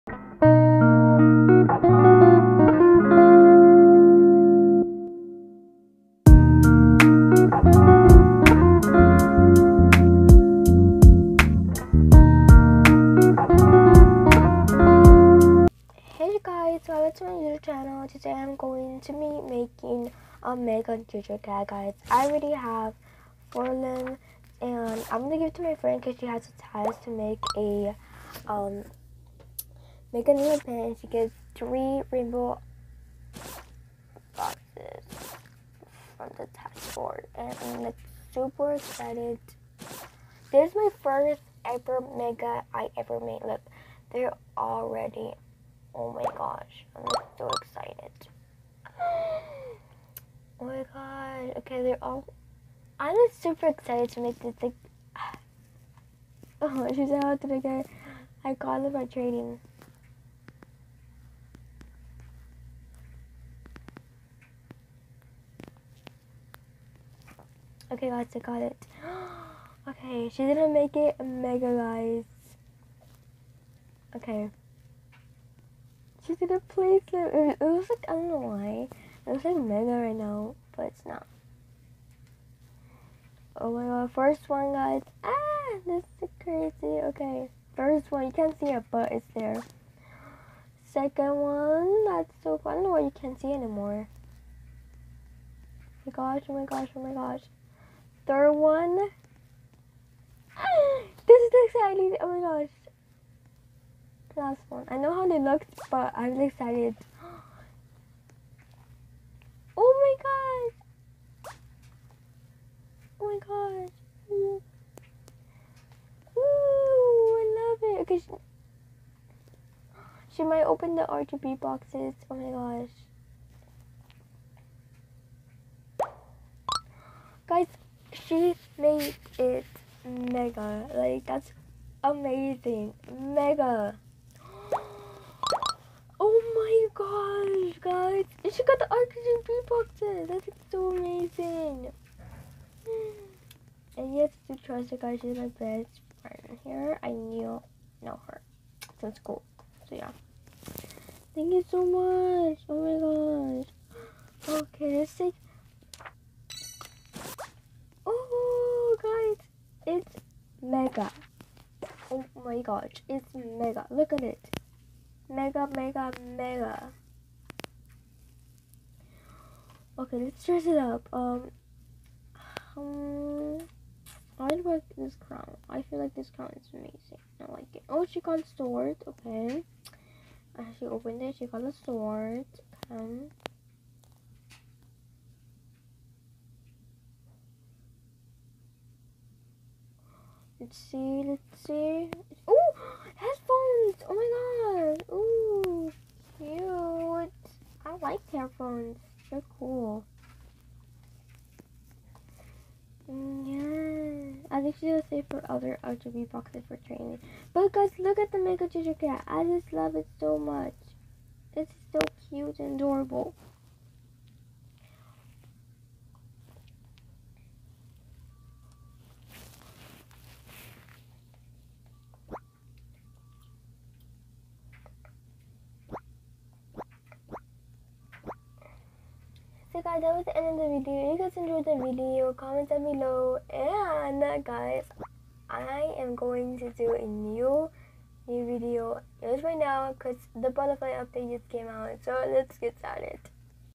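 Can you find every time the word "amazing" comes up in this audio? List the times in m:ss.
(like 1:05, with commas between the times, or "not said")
2:12, 2:20, 2:56.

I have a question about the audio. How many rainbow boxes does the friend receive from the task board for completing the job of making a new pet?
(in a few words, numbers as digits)
3.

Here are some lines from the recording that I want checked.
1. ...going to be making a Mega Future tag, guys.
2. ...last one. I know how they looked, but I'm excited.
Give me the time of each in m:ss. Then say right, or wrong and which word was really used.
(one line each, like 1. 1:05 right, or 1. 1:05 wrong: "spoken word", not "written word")
1. 0:18 right
2. 1:44 right.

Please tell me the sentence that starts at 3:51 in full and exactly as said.
If you guys enjoyed the video, comment down below.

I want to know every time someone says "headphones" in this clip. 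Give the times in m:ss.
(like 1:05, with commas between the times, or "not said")
3:13, 3:18.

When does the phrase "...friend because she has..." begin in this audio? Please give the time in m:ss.
0:25.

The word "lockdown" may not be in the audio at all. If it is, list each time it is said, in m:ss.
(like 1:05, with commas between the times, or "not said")
not said.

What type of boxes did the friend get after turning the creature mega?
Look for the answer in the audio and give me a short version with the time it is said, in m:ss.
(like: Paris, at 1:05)
oxygen bee boxes, at 2:18.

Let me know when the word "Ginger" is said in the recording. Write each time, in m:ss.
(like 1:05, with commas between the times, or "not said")
3:28.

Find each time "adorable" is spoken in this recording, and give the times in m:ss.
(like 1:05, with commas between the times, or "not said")
3:32.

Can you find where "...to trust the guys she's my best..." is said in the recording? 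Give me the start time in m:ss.
2:24.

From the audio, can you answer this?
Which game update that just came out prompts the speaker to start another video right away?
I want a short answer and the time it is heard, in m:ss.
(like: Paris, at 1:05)
Butterfly update, at 4:00.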